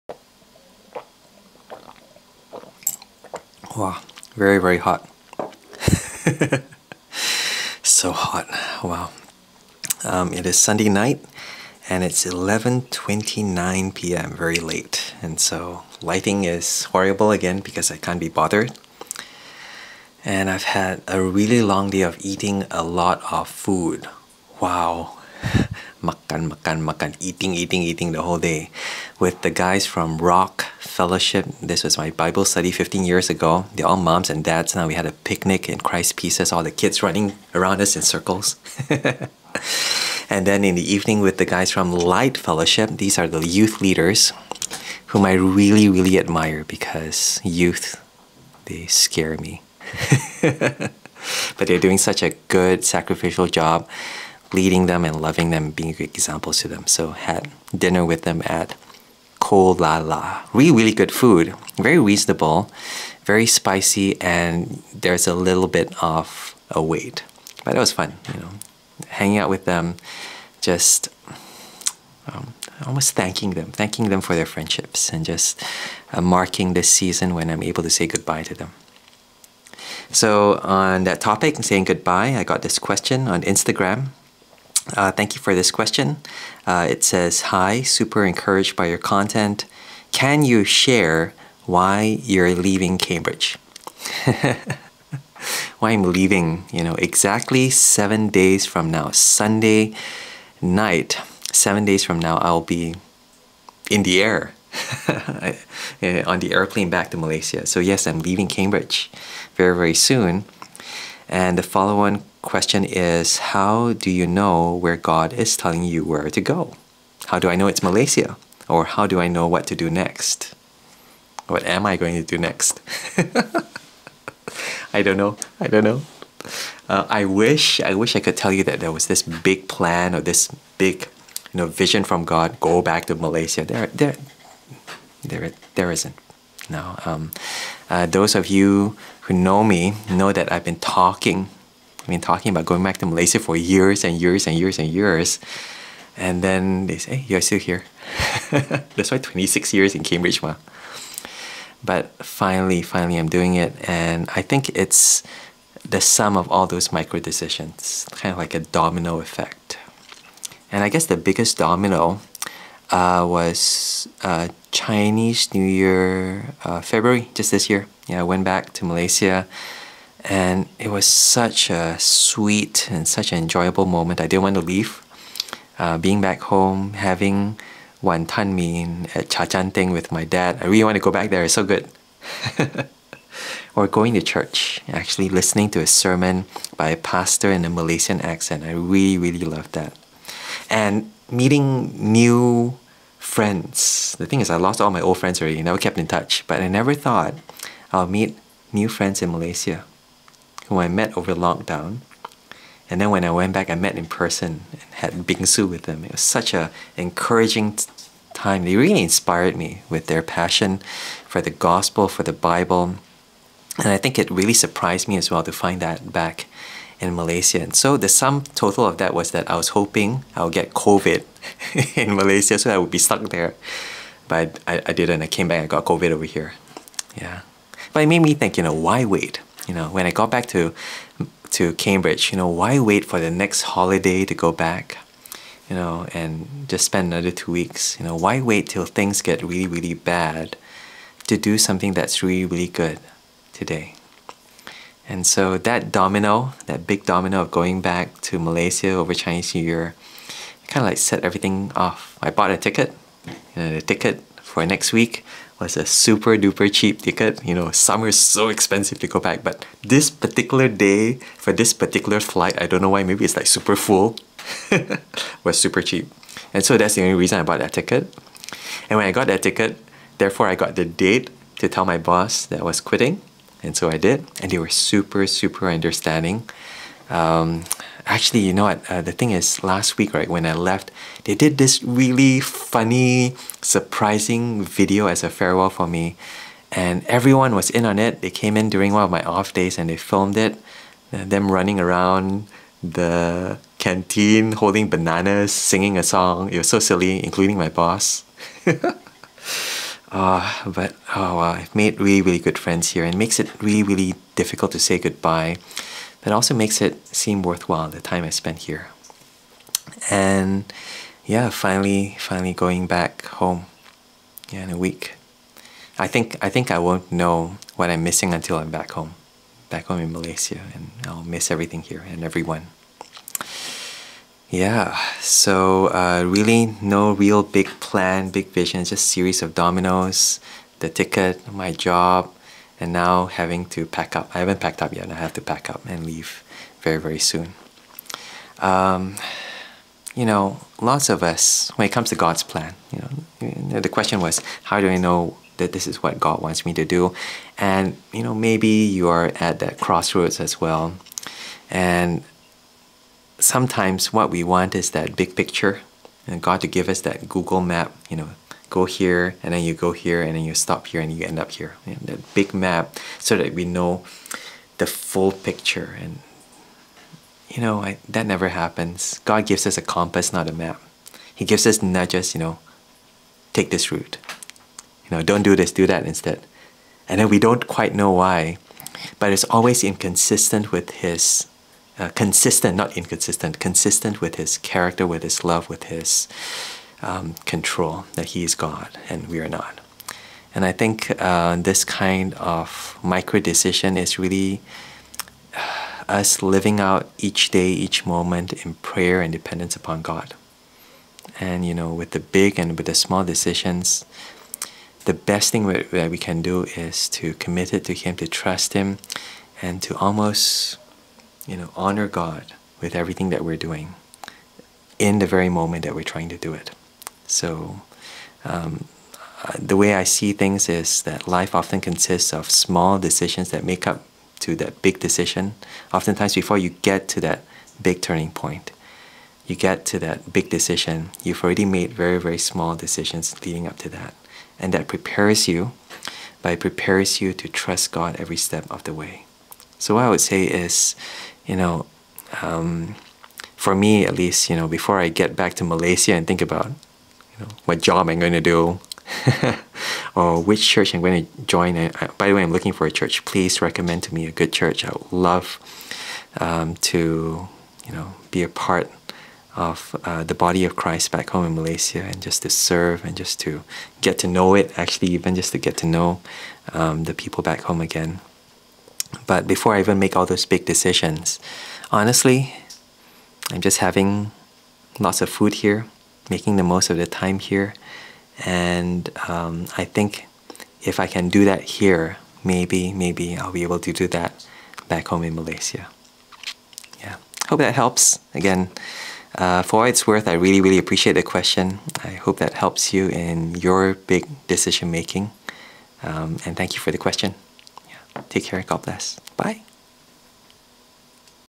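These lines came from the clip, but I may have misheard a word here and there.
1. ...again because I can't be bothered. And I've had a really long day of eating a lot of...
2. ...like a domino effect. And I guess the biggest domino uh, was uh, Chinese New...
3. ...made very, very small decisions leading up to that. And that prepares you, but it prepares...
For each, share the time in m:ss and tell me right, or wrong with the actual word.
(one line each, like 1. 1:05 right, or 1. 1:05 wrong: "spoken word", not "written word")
1. 0:17 right
2. 2:38 right
3. 7:11 right.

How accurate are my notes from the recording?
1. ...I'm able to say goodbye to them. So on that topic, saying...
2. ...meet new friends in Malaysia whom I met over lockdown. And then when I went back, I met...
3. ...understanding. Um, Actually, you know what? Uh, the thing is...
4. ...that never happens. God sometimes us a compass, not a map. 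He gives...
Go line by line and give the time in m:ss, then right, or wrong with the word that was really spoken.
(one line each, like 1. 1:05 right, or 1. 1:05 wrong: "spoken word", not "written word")
1. 1:17 right
2. 3:18 right
3. 4:35 right
4. 6:08 wrong: "gives", not "sometimes".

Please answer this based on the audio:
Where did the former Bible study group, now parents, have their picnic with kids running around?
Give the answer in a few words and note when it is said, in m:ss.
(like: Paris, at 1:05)
Christ Pieces, at 0:35.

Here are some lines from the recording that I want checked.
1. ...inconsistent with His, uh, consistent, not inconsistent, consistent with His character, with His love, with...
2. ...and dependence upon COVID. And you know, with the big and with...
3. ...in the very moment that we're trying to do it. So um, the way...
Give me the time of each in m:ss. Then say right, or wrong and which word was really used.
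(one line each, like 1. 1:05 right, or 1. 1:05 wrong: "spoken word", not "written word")
1. 6:19 right
2. 6:39 wrong: "God", not "COVID"
3. 6:54 right.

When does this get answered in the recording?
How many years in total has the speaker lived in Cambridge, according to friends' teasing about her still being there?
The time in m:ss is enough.
2:29.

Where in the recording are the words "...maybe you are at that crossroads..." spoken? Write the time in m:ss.
5:48.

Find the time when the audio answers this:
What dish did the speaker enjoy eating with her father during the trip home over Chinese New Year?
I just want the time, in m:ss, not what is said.
2:58.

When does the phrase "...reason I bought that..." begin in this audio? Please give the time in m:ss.
4:27.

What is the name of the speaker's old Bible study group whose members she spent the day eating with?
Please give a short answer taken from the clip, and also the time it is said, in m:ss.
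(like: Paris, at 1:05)
Rock Fellowship, at 0:30.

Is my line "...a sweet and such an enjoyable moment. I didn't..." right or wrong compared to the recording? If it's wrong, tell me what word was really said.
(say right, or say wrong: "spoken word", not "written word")
right.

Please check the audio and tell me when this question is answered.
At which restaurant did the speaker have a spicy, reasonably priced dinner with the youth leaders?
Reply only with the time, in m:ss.
0:59.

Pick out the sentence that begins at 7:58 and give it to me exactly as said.
And um, I think if I can do that here, maybe, maybe I'll be able to do that back home in Malaysia.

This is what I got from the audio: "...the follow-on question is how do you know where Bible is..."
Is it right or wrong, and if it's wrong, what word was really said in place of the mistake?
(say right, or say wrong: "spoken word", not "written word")
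wrong: "God", not "Bible".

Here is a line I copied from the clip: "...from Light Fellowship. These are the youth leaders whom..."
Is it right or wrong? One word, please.
right.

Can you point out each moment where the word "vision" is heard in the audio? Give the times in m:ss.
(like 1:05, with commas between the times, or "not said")
2:11, 5:28.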